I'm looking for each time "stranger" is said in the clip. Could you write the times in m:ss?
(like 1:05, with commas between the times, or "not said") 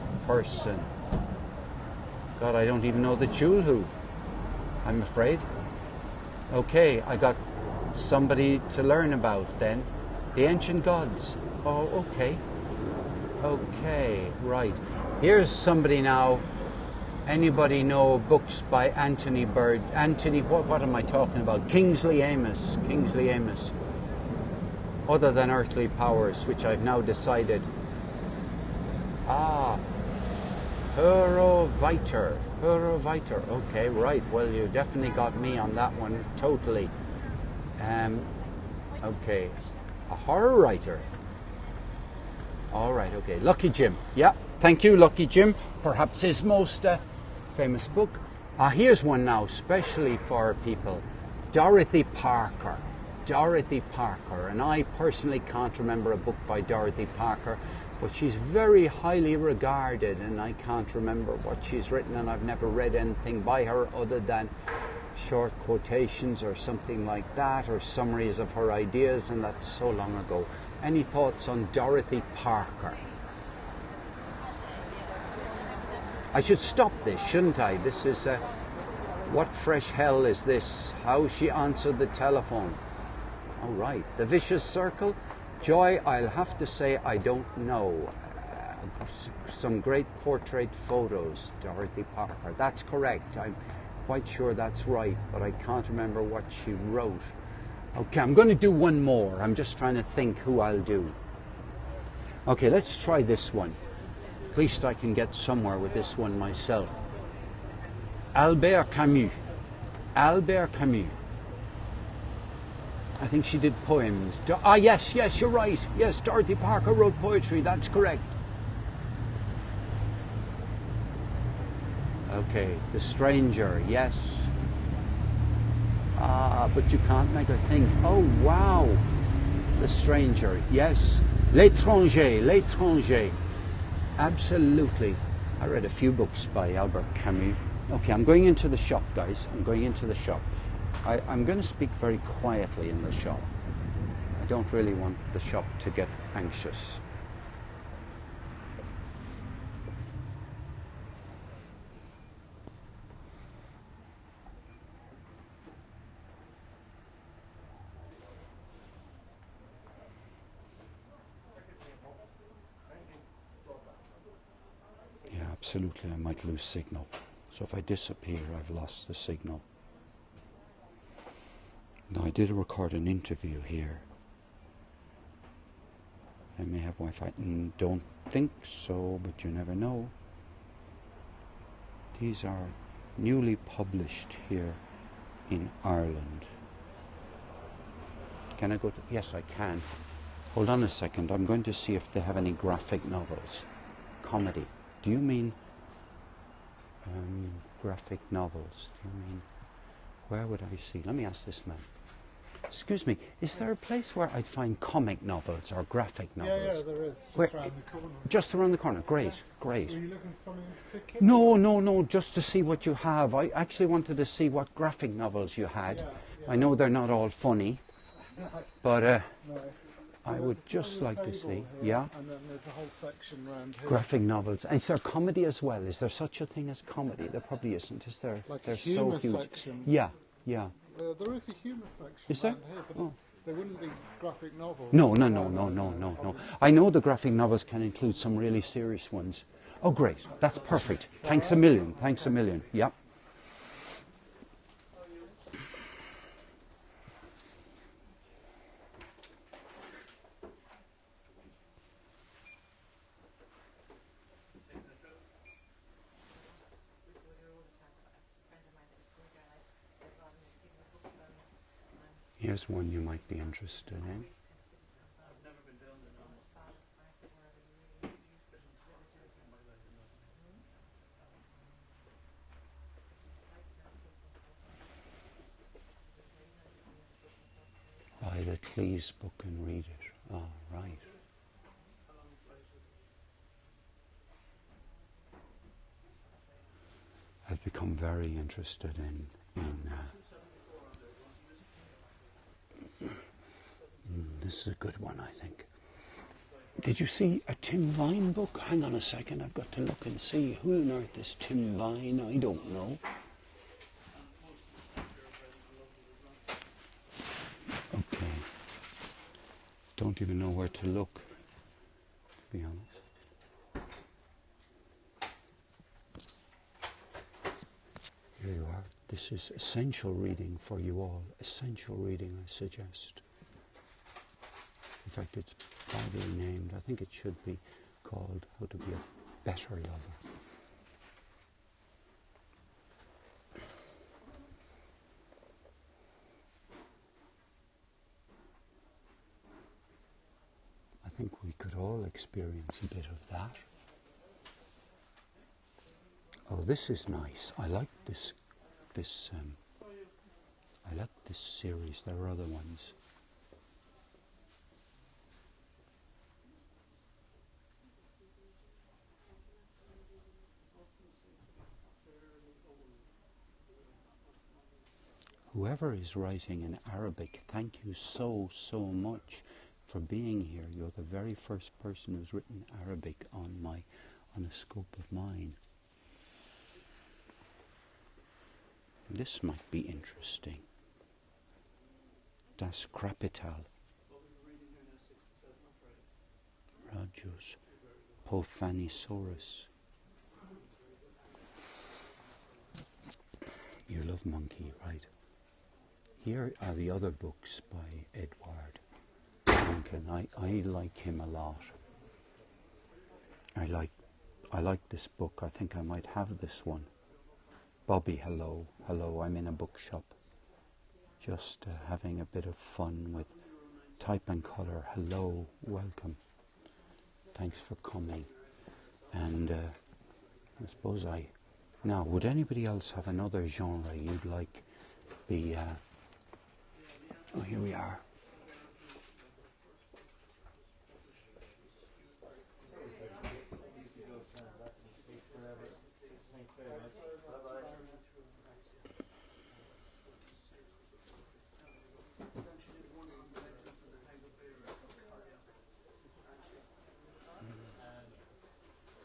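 2:02, 2:09.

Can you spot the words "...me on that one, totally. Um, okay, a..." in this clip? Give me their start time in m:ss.
0:35.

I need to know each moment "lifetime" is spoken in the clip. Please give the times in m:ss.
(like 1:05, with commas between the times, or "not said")
not said.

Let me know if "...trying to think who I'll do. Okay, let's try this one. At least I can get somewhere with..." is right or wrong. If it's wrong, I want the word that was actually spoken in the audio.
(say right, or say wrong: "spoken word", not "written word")
right.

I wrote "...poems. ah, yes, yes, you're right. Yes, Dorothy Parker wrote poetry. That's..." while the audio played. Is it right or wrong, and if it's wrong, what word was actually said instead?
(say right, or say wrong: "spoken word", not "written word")
right.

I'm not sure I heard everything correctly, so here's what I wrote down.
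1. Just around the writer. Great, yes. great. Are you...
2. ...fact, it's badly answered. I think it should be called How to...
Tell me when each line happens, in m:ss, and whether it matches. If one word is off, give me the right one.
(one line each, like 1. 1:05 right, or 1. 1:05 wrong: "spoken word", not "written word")
1. 3:28 wrong: "corner", not "writer"
2. 5:25 wrong: "named", not "answered".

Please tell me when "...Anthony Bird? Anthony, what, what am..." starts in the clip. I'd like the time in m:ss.
0:18.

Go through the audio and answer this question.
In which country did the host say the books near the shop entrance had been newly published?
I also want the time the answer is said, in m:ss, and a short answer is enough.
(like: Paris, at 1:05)
Ireland, at 3:05.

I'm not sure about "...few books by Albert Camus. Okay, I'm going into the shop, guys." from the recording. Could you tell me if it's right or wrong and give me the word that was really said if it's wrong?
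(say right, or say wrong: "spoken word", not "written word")
right.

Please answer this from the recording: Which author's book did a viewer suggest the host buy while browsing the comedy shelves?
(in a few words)
Cleese.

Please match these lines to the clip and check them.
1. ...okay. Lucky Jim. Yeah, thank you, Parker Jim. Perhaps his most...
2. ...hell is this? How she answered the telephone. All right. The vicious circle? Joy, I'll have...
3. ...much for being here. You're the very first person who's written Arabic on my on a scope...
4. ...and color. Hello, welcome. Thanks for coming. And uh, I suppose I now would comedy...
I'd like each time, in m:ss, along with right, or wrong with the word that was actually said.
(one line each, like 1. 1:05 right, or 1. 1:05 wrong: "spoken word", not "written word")
1. 0:43 wrong: "Lucky", not "Parker"
2. 1:19 right
3. 6:08 right
4. 6:54 wrong: "anybody", not "comedy".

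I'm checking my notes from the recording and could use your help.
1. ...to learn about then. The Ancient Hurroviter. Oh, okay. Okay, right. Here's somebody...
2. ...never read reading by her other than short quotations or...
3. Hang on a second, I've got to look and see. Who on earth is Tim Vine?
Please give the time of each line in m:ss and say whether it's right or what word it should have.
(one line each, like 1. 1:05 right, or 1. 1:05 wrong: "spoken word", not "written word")
1. 0:08 wrong: "Gods", not "Hurroviter"
2. 1:02 wrong: "anything", not "reading"
3. 4:58 right.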